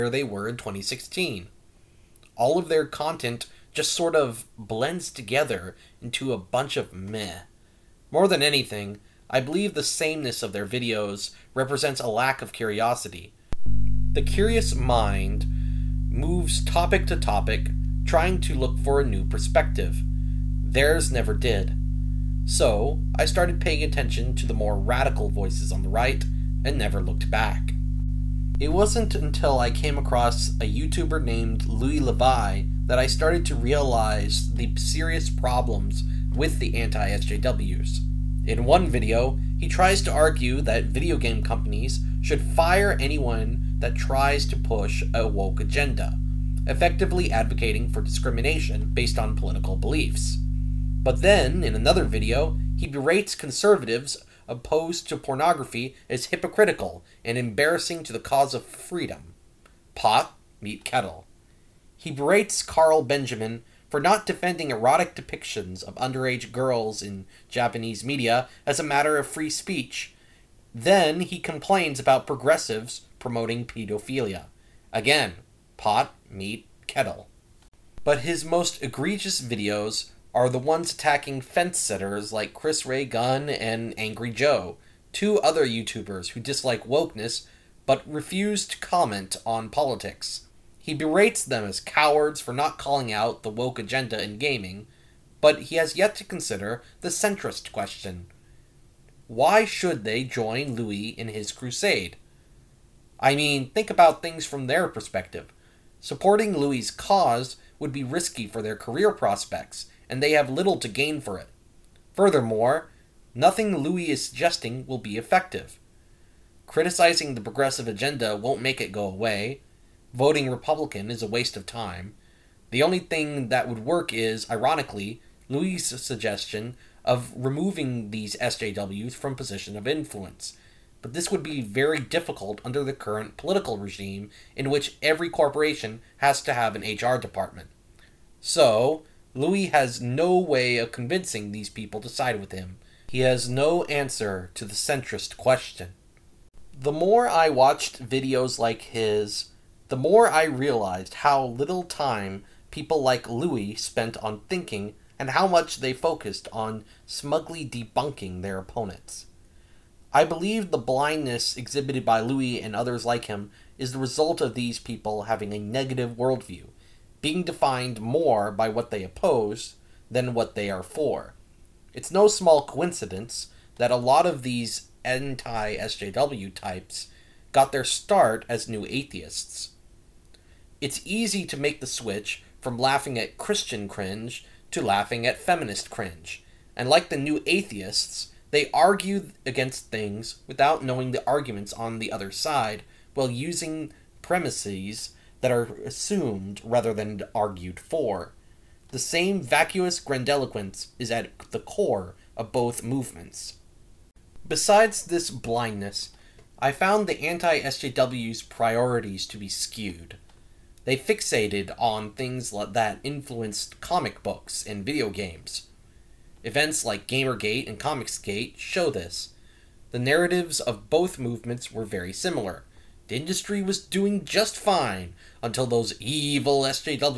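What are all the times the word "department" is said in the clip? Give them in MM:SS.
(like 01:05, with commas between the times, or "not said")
02:17.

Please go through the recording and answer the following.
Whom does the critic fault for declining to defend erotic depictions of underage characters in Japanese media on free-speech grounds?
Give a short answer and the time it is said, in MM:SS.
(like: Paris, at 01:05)
Carl Benjamin, at 01:02.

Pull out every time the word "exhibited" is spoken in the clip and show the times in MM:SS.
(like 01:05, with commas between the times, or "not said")
02:41.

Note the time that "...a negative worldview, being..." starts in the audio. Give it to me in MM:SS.
02:45.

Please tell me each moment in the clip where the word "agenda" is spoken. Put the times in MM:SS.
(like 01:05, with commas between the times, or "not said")
00:45, 01:33, 01:57.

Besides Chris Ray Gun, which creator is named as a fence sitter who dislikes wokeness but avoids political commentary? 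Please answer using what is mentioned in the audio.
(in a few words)
Angry Joe.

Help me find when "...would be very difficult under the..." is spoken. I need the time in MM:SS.
02:11.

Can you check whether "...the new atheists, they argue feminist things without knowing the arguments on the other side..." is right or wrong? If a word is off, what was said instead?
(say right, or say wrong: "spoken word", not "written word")
wrong: "against", not "feminist".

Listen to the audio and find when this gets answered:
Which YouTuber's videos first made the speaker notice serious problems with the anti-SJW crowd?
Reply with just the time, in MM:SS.
00:31.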